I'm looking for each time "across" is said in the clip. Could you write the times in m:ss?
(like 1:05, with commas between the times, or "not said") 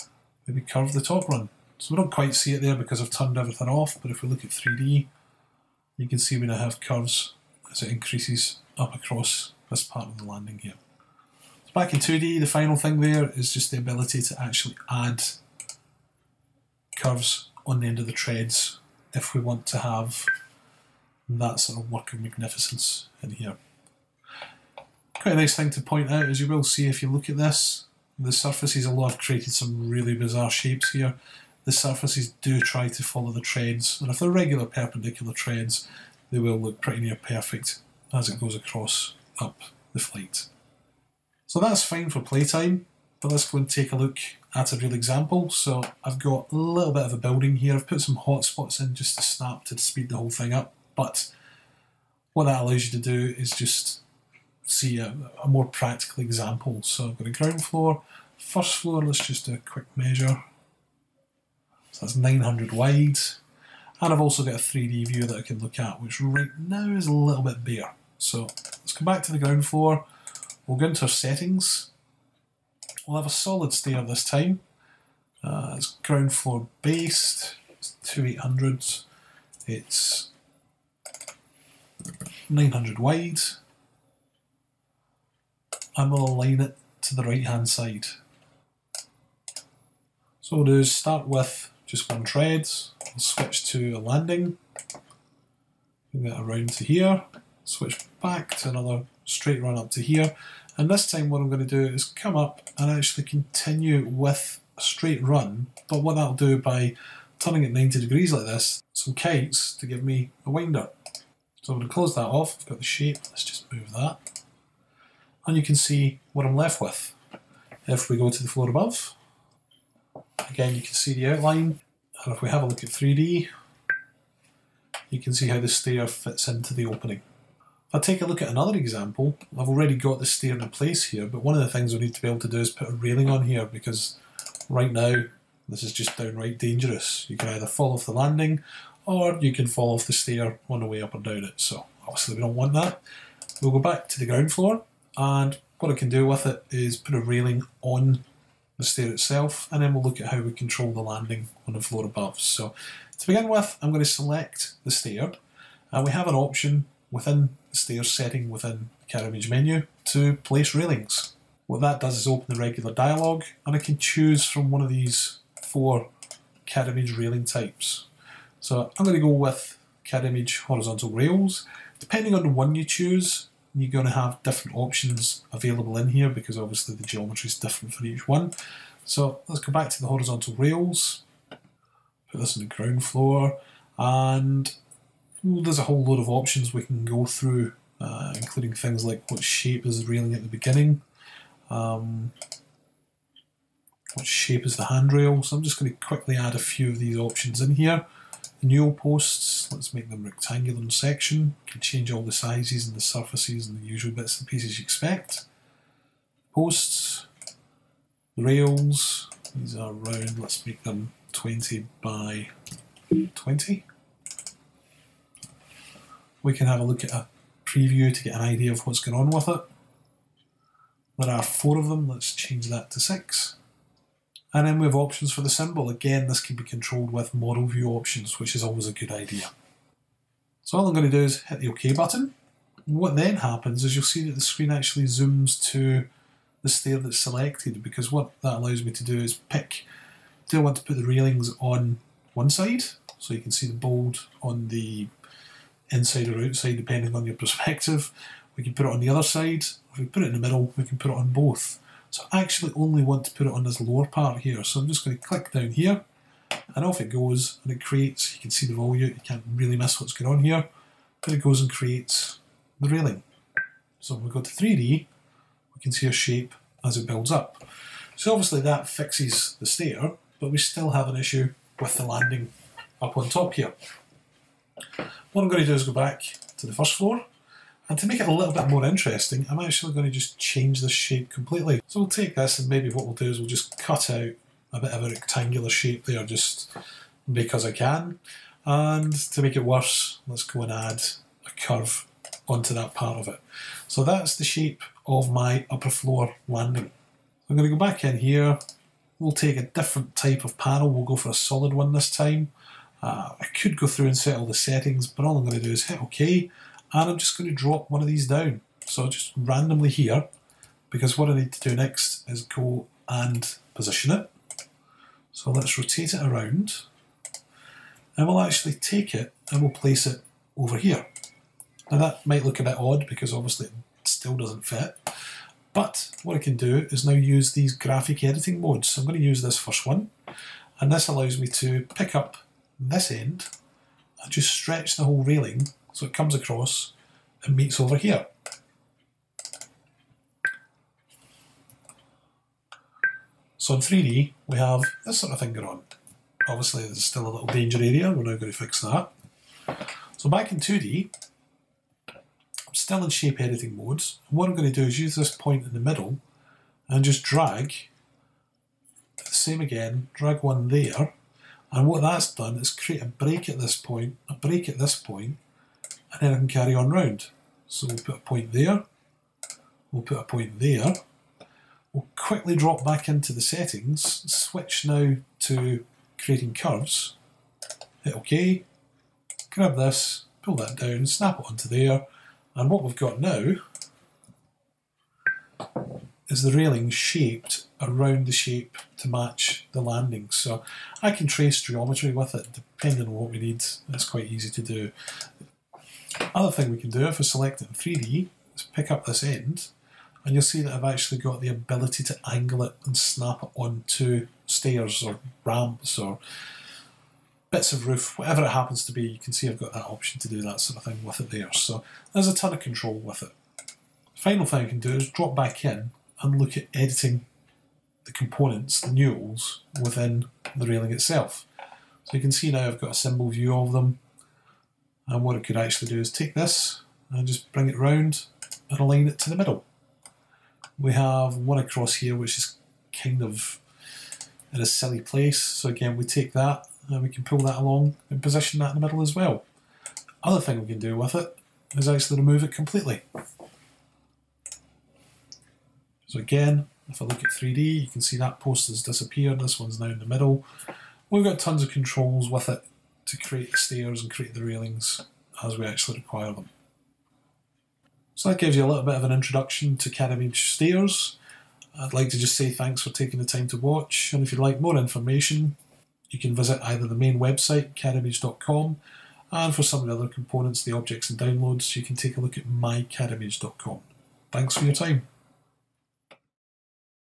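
0:08, 0:38, 5:36, 7:11.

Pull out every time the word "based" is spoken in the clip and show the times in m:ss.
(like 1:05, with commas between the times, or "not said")
1:16.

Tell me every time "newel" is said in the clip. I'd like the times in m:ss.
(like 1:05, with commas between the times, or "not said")
3:18, 6:58.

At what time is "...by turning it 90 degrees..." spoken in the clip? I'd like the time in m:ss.
1:46.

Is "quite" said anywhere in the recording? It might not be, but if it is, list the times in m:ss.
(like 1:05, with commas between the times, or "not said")
0:02, 0:25, 6:34.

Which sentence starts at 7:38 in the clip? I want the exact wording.
So that gives you a little bit of an introduction to Cadimage Stairs.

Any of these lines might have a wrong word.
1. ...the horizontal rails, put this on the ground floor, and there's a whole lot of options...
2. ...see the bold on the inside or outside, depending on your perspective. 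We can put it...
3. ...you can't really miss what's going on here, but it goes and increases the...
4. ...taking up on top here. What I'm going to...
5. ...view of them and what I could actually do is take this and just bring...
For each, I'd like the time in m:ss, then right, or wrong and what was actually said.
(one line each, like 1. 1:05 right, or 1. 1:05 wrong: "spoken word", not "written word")
1. 2:59 right
2. 4:03 right
3. 4:19 wrong: "creates", not "increases"
4. 4:32 wrong: "landing", not "taking"
5. 7:03 right.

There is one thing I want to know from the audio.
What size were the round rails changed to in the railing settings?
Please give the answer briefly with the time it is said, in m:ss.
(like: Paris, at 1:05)
20 by 20, at 3:31.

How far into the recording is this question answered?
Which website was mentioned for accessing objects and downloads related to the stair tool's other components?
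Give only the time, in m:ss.
7:52.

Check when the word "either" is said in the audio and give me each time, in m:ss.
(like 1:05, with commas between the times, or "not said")
2:17, 7:46.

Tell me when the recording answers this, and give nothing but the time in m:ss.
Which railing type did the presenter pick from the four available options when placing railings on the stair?
2:50.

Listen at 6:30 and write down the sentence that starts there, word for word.
So I can trace geometry with it depending on what we need.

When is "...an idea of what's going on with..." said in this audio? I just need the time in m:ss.
3:38.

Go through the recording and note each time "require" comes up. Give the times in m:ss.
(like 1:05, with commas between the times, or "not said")
7:35.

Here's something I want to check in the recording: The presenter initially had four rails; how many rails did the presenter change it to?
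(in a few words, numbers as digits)
6.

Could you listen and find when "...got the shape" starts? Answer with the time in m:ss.
1:52.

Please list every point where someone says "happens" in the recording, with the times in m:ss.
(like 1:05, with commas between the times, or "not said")
3:53, 6:48.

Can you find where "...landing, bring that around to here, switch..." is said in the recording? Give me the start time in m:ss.
1:33.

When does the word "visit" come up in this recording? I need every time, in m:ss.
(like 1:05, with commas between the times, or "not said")
7:46.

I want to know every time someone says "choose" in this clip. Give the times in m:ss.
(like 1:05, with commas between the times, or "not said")
2:43, 2:52.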